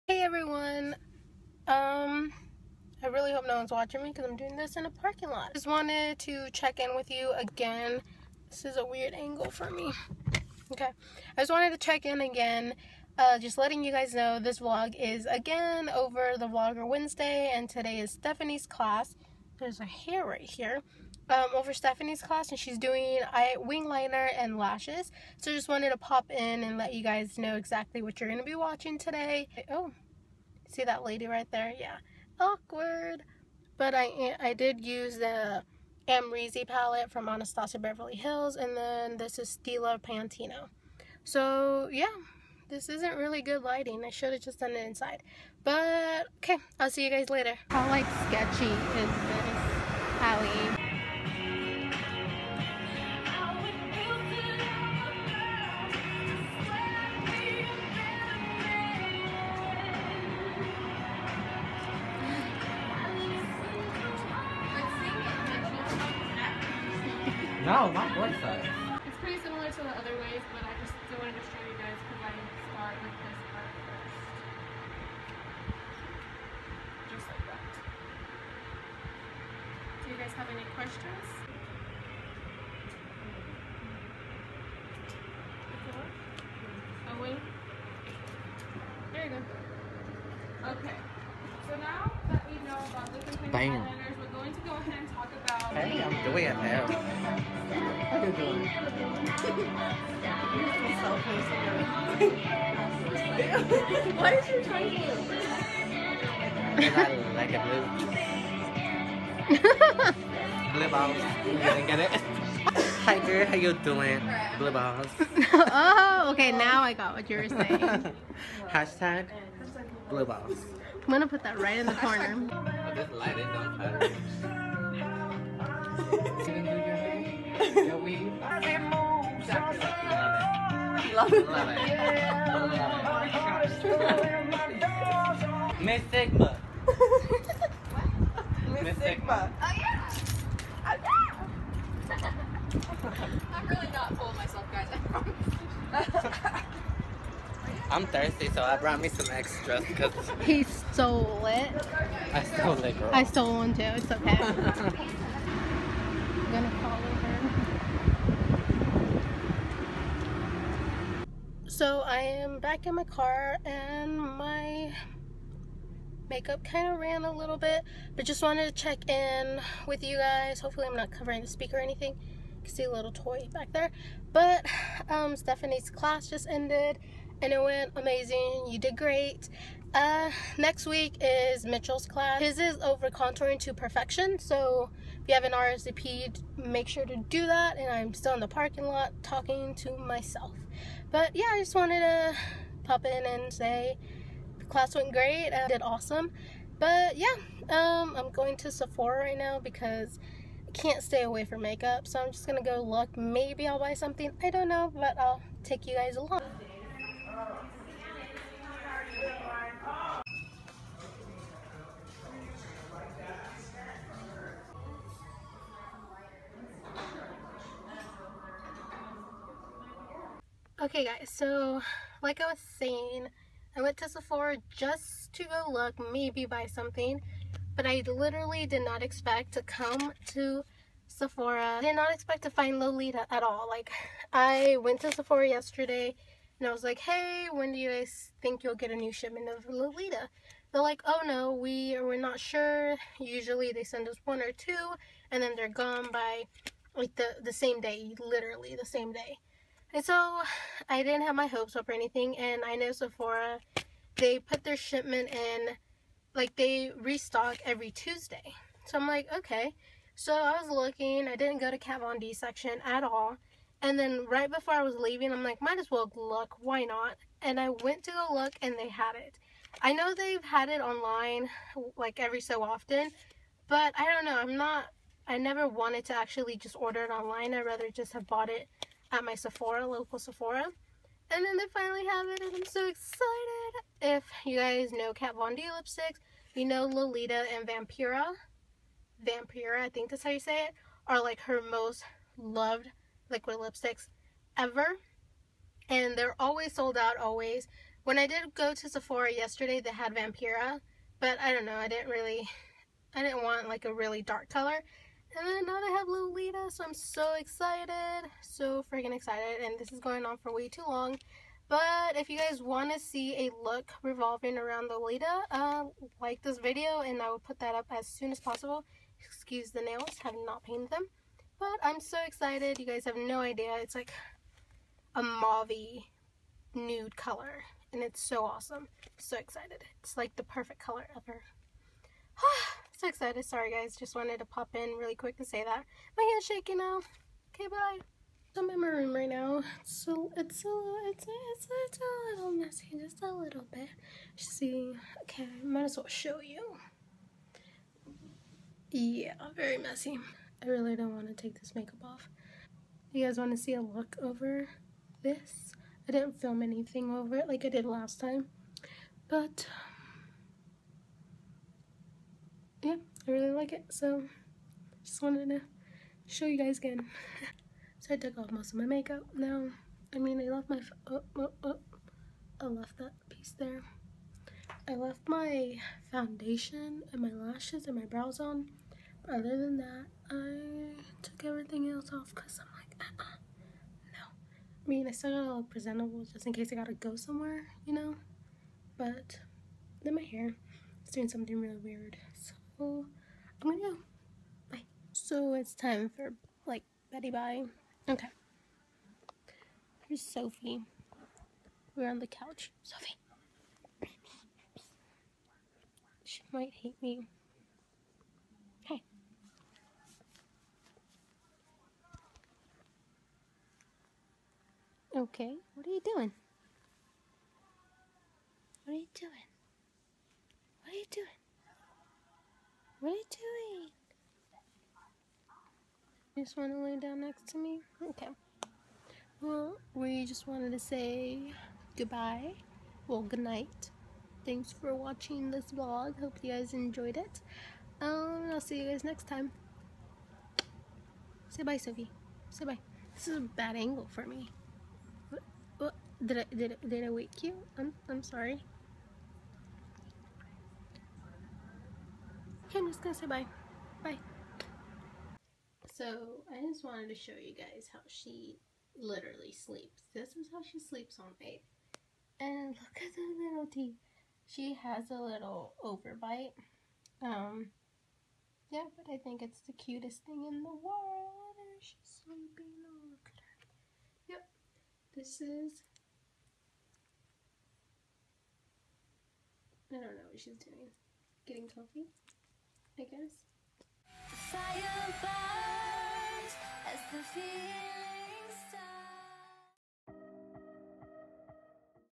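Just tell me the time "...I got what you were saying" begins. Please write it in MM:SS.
01:56.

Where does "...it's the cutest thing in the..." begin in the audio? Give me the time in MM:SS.
07:49.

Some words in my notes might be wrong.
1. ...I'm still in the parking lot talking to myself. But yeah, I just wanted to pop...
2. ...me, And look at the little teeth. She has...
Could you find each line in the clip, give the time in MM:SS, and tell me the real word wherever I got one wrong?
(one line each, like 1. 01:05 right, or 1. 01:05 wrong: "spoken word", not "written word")
1. 03:07 right
2. 07:41 right.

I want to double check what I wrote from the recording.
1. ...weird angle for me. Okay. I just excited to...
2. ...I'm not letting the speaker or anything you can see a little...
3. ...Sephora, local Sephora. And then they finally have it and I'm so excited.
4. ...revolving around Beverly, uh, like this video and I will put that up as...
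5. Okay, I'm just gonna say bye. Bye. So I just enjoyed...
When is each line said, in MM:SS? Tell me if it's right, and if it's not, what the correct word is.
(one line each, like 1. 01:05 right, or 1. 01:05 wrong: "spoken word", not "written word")
1. 00:08 wrong: "wanted", not "excited"
2. 02:50 wrong: "covering", not "letting"
3. 04:39 right
4. 05:14 wrong: "Lolita", not "Beverly"
5. 07:32 wrong: "wanted", not "enjoyed".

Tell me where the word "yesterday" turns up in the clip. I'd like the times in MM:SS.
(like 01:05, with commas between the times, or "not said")
03:55, 04:59.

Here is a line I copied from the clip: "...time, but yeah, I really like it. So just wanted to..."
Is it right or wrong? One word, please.
right.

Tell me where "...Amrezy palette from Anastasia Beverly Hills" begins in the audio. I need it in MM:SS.
00:36.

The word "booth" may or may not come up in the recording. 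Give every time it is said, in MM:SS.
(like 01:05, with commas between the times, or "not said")
not said.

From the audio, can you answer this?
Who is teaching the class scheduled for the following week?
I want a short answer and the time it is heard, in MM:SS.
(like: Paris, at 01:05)
Mitchel, at 03:00.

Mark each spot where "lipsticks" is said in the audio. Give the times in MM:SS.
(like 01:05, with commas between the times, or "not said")
04:45, 04:53.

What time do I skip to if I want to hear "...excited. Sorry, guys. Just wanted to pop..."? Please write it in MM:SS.
05:33.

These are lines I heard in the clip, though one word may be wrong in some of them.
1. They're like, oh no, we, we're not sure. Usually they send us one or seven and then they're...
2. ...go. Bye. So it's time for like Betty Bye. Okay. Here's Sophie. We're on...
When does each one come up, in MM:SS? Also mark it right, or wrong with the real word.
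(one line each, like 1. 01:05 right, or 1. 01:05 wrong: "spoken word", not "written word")
1. 04:00 wrong: "two", not "seven"
2. 06:33 right.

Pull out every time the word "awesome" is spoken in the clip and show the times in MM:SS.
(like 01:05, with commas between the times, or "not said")
03:15, 05:28.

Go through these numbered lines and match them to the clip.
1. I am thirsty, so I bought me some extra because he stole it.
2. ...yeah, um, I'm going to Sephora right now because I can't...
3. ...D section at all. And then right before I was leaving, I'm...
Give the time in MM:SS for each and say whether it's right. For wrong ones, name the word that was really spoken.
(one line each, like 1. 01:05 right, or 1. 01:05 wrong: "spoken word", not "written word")
1. 02:27 wrong: "brought", not "bought"
2. 03:17 right
3. 04:22 right.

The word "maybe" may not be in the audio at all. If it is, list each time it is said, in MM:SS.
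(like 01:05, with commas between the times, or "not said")
03:23, 03:46.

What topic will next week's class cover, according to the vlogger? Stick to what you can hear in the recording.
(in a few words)
contouring to perfection.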